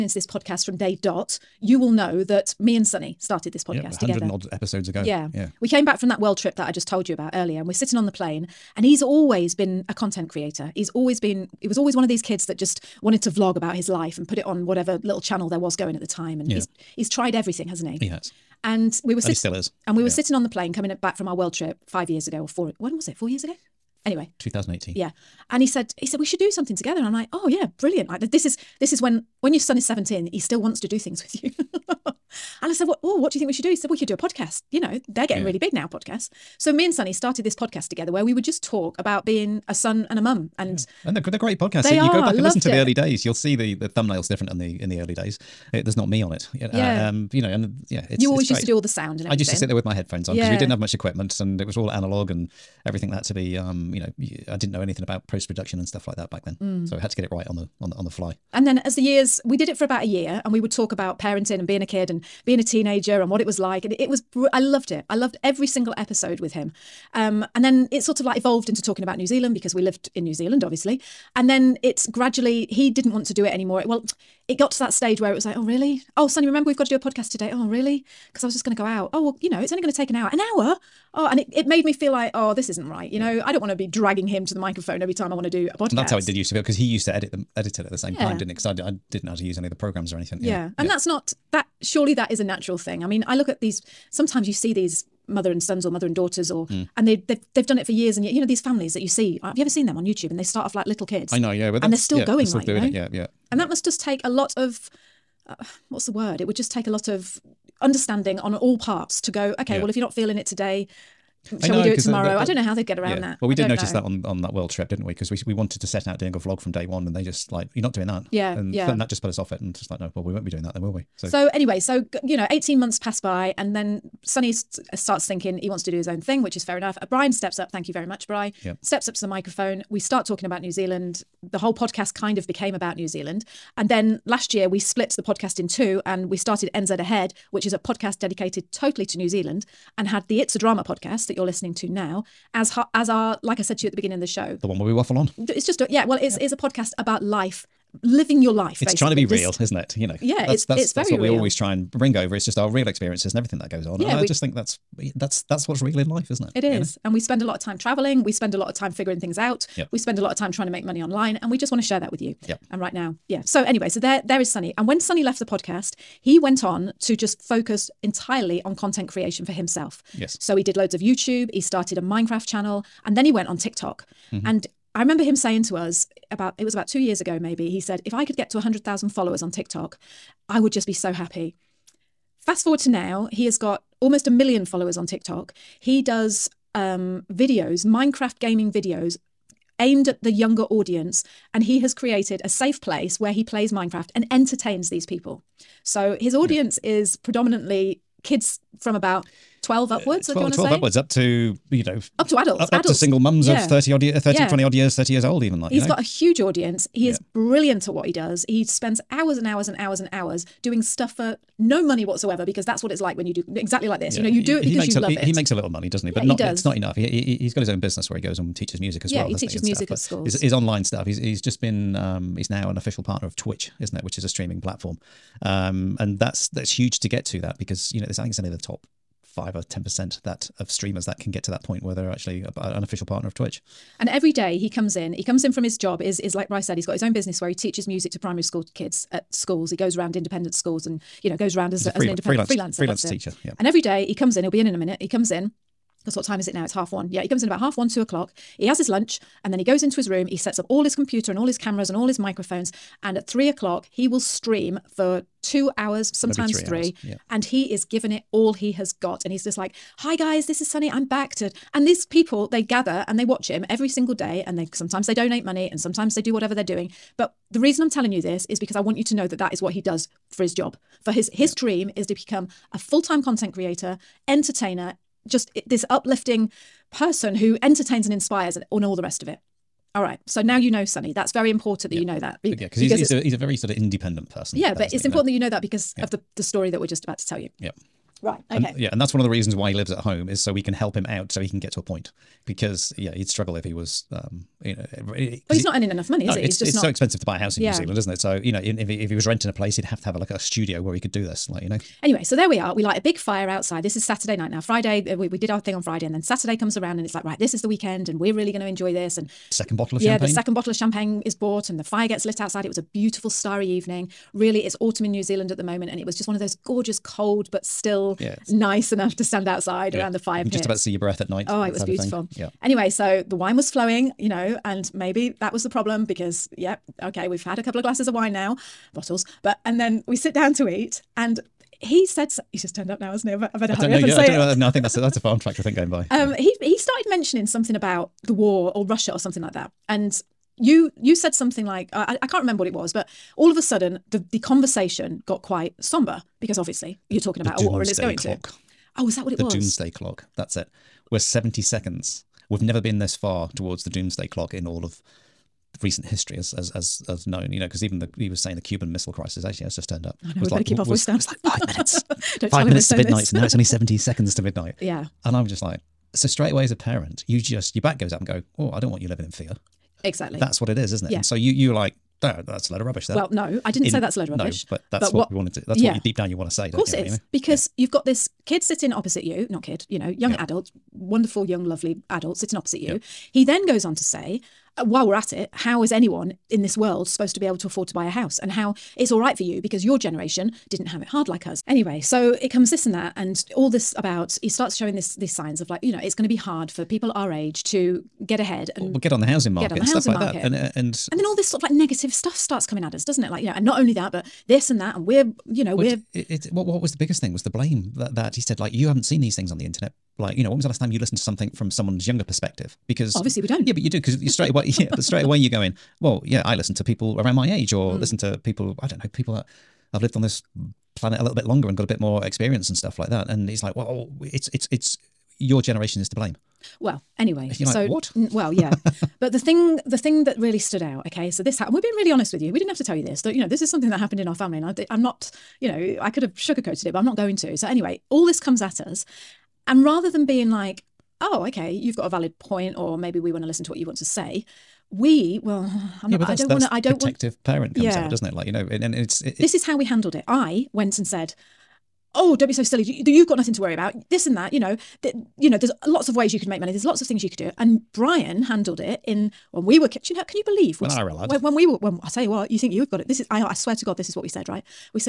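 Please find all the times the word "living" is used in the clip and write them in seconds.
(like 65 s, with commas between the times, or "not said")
148 s, 369 s.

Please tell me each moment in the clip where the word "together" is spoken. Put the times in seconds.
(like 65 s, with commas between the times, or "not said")
4 s, 26 s, 37 s.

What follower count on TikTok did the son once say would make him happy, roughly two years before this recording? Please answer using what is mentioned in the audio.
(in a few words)
100000.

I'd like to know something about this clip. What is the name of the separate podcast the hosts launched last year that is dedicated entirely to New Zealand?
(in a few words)
NZ Ahead.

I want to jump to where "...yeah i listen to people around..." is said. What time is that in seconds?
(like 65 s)
416 s.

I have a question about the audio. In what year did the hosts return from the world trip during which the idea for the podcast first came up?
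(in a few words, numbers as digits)
2018.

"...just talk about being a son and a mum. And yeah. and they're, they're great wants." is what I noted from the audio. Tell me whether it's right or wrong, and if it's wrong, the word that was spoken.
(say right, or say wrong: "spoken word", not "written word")
wrong: "podcasts", not "wants".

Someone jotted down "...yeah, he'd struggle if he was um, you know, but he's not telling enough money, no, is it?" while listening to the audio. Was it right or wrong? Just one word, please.
wrong.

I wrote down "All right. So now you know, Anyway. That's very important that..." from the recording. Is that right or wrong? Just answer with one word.
wrong.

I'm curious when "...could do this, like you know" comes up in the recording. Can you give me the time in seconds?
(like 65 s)
300 s.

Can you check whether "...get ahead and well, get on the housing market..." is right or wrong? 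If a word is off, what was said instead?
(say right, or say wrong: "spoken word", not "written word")
right.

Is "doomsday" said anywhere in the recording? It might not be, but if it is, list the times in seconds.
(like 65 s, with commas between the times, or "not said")
349 s, 353 s.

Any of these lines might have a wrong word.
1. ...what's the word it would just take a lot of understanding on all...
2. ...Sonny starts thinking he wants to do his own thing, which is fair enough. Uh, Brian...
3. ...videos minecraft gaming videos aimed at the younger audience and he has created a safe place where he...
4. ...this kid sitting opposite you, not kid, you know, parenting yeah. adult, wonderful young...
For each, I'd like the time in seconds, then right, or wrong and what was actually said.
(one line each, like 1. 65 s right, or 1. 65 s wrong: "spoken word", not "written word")
1. 105 s right
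2. 124 s right
3. 187 s right
4. 378 s wrong: "young", not "parenting".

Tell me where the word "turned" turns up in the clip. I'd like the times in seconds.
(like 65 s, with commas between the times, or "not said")
332 s, 359 s.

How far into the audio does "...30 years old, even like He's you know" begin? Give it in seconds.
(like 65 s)
204 s.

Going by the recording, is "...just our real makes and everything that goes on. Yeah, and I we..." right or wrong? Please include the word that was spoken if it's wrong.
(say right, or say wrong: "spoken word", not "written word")
wrong: "experiences", not "makes".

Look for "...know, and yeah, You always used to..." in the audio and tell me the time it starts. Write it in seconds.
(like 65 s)
47 s.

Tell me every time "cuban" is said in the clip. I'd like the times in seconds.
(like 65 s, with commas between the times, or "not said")
358 s.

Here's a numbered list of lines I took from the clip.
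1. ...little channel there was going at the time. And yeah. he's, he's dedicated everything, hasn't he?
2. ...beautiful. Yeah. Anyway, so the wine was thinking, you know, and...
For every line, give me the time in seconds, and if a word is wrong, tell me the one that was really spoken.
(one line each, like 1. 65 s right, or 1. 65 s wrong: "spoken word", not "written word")
1. 15 s wrong: "tried", not "dedicated"
2. 321 s wrong: "flowing", not "thinking".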